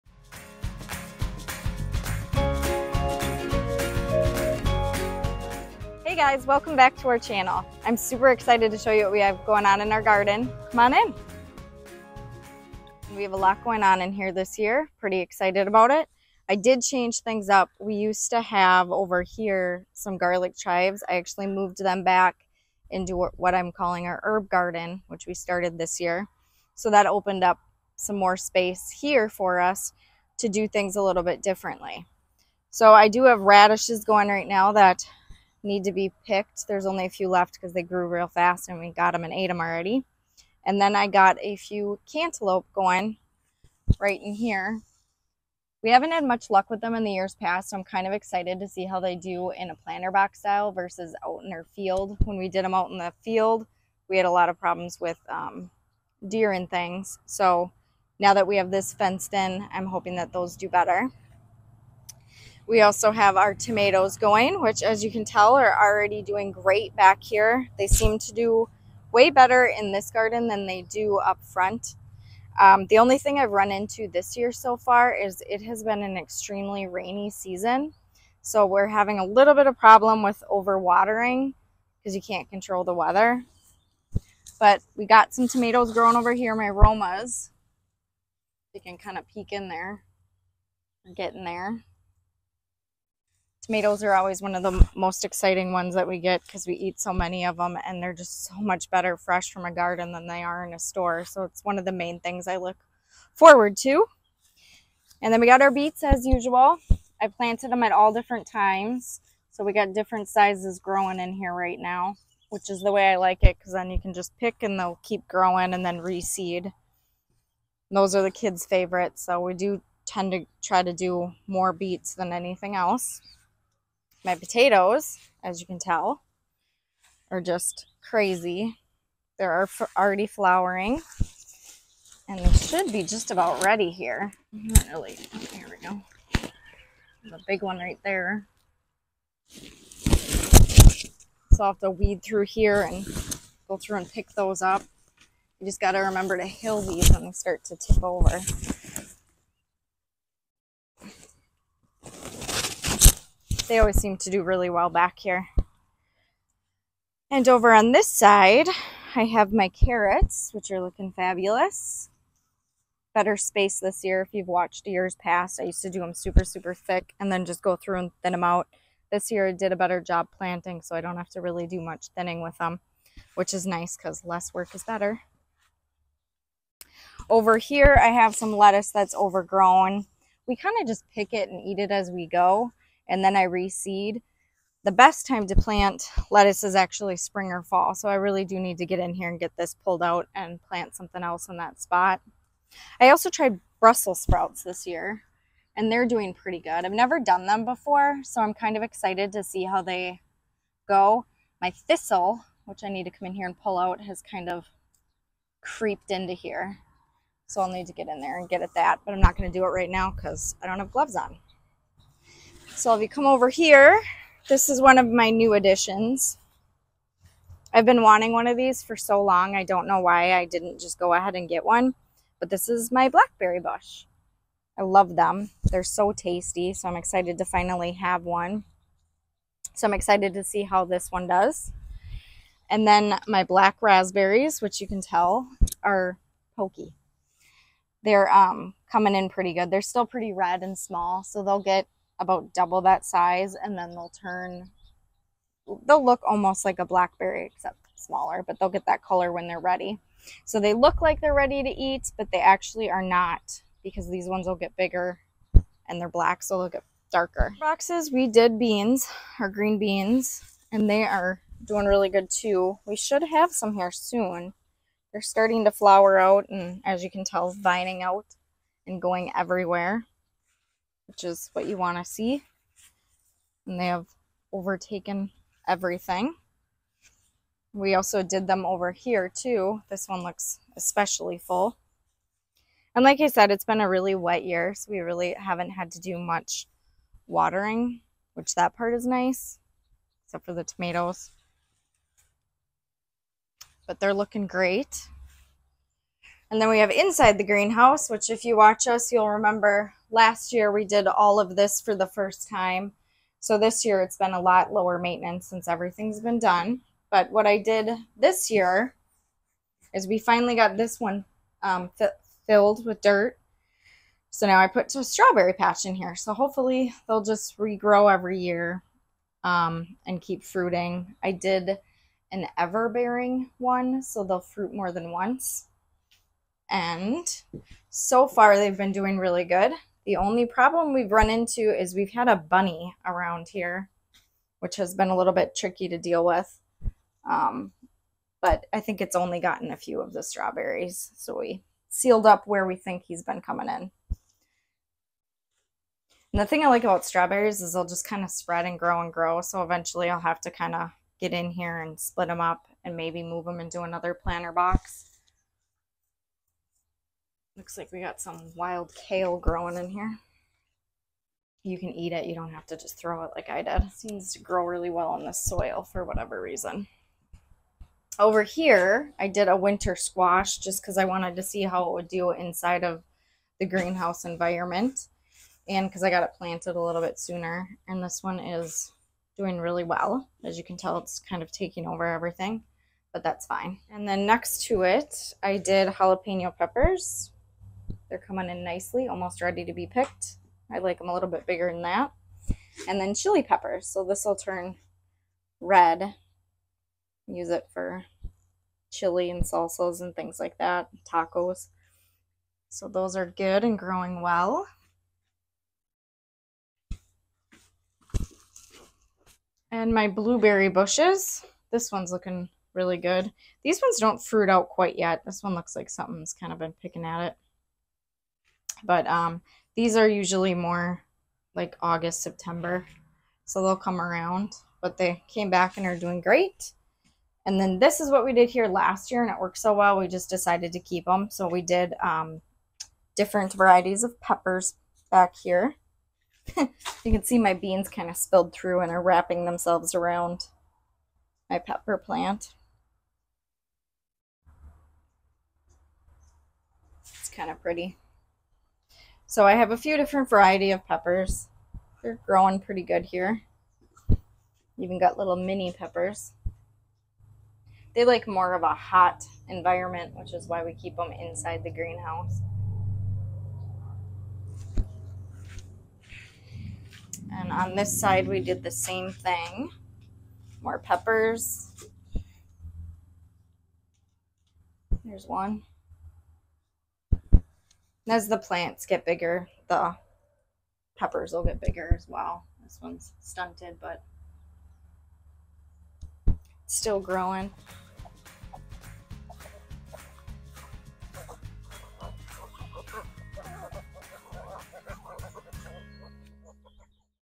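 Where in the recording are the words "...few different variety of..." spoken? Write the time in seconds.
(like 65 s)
449 s.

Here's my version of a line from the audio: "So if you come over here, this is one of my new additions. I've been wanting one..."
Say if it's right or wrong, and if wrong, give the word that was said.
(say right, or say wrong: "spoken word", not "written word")
right.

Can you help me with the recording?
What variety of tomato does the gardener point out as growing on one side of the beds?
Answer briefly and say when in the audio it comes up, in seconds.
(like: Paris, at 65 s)
Romas, at 86 s.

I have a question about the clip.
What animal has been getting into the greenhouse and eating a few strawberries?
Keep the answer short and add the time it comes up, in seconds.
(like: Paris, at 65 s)
A bunny, at 332 s.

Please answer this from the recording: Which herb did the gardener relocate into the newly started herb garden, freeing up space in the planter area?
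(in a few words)
Garlic chives.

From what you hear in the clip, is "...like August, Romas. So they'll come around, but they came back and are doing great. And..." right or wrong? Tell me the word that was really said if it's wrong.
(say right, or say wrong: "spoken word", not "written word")
wrong: "September", not "Romas".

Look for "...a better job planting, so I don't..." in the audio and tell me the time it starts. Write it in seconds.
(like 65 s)
169 s.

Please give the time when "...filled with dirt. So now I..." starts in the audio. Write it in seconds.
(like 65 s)
312 s.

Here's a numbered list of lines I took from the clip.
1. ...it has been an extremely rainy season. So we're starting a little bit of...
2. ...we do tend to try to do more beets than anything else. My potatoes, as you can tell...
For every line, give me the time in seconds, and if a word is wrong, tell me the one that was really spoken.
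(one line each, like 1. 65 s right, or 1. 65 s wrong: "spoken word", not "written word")
1. 75 s wrong: "having", not "starting"
2. 119 s right.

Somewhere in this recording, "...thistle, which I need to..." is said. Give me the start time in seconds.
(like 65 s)
201 s.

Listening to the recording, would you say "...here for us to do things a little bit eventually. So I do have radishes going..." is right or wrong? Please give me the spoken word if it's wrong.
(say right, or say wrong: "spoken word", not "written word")
wrong: "differently", not "eventually".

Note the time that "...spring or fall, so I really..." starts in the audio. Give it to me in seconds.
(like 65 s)
187 s.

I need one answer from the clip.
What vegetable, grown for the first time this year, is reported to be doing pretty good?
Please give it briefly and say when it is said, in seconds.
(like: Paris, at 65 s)
Brussels sprouts, at 193 s.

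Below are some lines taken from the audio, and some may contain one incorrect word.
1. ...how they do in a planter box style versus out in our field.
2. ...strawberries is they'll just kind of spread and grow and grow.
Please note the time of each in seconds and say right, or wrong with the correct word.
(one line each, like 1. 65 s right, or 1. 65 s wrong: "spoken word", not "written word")
1. 48 s right
2. 347 s right.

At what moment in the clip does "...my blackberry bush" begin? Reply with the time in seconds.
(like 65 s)
222 s.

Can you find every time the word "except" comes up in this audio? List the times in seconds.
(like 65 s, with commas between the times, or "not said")
247 s, 290 s.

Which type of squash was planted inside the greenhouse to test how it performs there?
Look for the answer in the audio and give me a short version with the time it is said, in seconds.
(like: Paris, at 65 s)
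Winter squash, at 369 s.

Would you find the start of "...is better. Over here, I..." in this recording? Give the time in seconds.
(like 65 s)
174 s.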